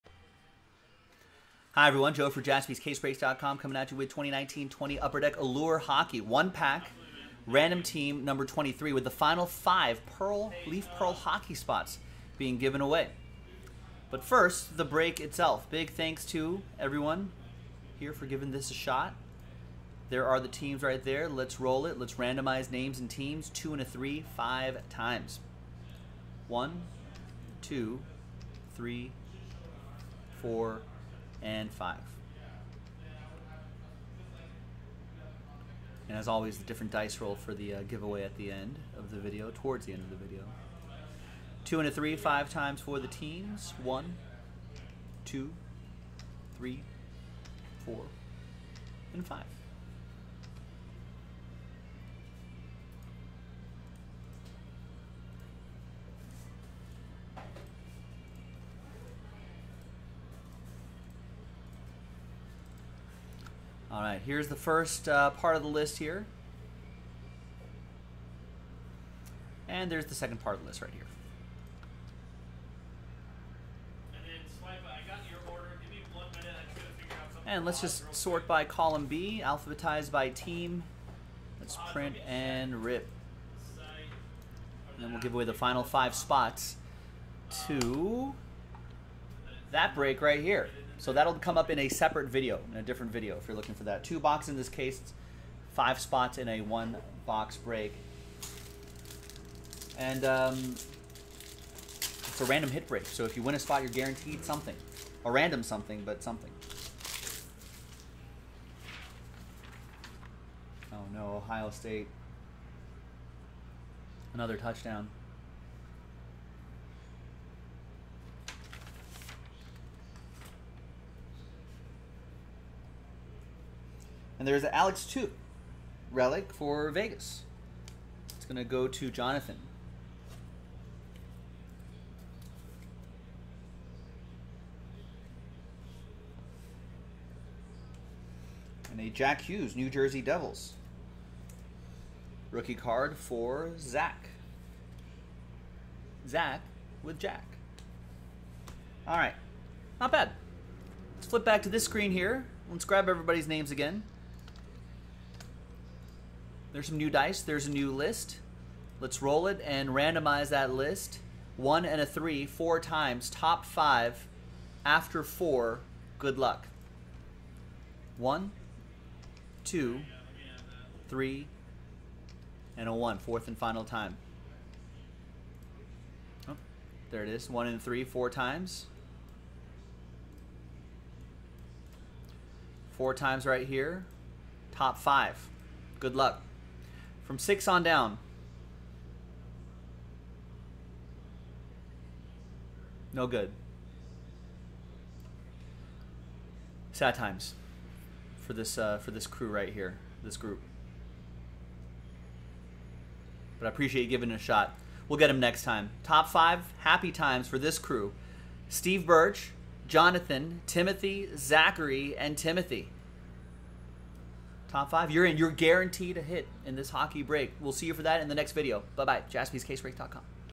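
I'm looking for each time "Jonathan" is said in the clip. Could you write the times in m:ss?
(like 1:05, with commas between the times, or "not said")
2:09, 3:29.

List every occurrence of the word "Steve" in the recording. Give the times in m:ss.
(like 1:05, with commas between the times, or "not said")
3:28.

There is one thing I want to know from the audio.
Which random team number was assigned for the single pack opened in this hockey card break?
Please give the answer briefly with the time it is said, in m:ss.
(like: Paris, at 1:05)
23, at 0:08.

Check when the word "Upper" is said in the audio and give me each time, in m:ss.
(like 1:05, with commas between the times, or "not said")
0:05.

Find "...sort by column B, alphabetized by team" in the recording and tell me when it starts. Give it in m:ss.
1:18.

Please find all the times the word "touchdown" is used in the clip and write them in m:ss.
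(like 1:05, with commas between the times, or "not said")
1:54.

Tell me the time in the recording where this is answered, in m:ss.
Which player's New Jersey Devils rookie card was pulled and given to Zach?
2:19.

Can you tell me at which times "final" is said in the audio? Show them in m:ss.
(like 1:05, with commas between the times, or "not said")
0:09, 1:25, 2:53.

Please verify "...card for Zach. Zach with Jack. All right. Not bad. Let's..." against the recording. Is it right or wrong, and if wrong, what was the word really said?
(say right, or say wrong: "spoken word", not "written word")
right.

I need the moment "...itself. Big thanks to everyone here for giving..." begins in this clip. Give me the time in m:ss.
0:15.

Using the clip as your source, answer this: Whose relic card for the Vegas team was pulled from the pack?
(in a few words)
Alex Tuch.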